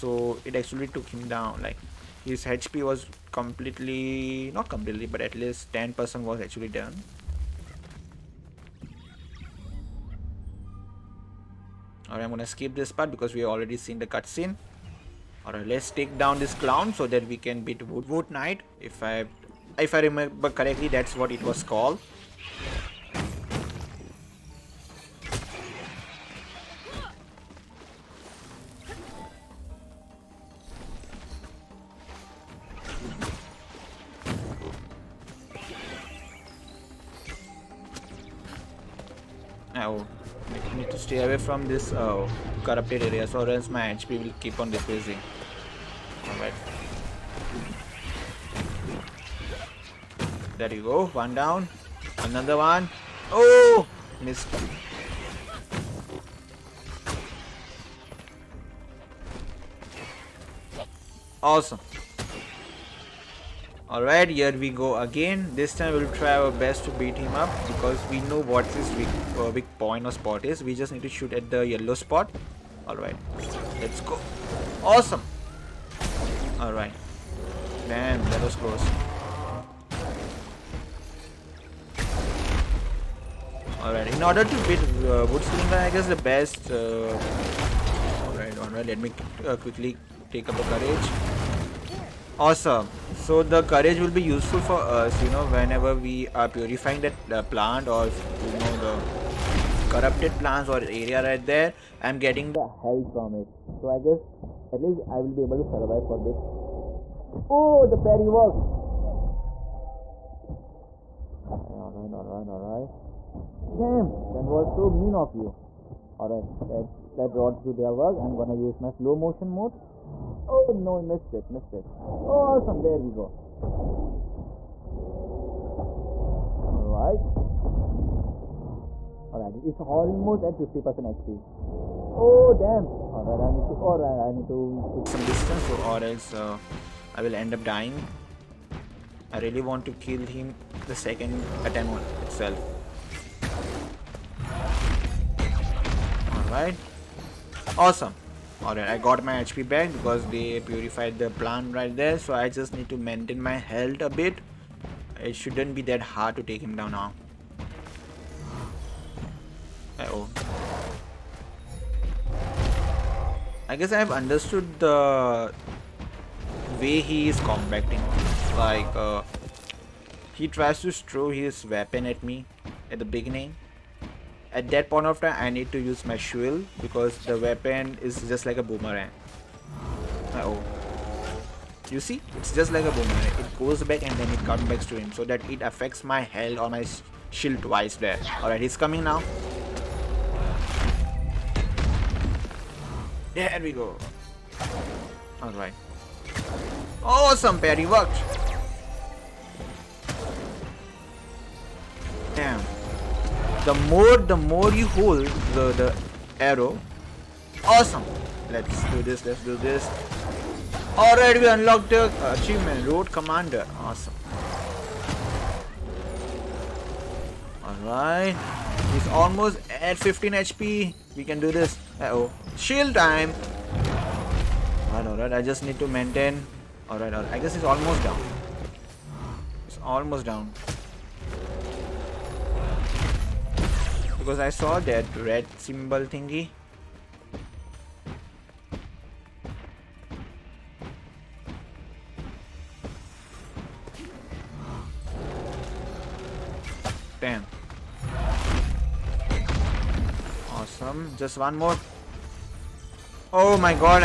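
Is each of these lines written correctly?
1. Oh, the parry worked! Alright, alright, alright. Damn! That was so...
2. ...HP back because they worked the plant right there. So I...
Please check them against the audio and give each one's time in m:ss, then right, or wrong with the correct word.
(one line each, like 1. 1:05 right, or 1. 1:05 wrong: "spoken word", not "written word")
1. 1:47 right
2. 2:29 wrong: "purified", not "worked".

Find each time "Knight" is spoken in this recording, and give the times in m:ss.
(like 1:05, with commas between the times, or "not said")
0:18.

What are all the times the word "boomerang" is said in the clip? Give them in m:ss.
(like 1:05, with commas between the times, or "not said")
2:58, 3:02.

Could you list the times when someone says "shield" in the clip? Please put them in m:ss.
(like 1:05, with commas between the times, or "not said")
2:56, 3:07, 3:42.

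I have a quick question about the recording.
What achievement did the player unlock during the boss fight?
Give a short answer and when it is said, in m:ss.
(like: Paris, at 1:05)
Road Commander, at 3:32.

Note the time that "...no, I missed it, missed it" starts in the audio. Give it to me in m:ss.
2:00.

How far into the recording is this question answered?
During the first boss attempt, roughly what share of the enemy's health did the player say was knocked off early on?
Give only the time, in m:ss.
0:05.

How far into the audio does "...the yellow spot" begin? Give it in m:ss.
1:11.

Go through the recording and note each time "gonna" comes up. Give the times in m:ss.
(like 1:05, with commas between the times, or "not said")
0:12, 1:58.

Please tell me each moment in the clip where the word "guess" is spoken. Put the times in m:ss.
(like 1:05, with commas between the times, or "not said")
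1:25, 1:43, 2:43, 3:47.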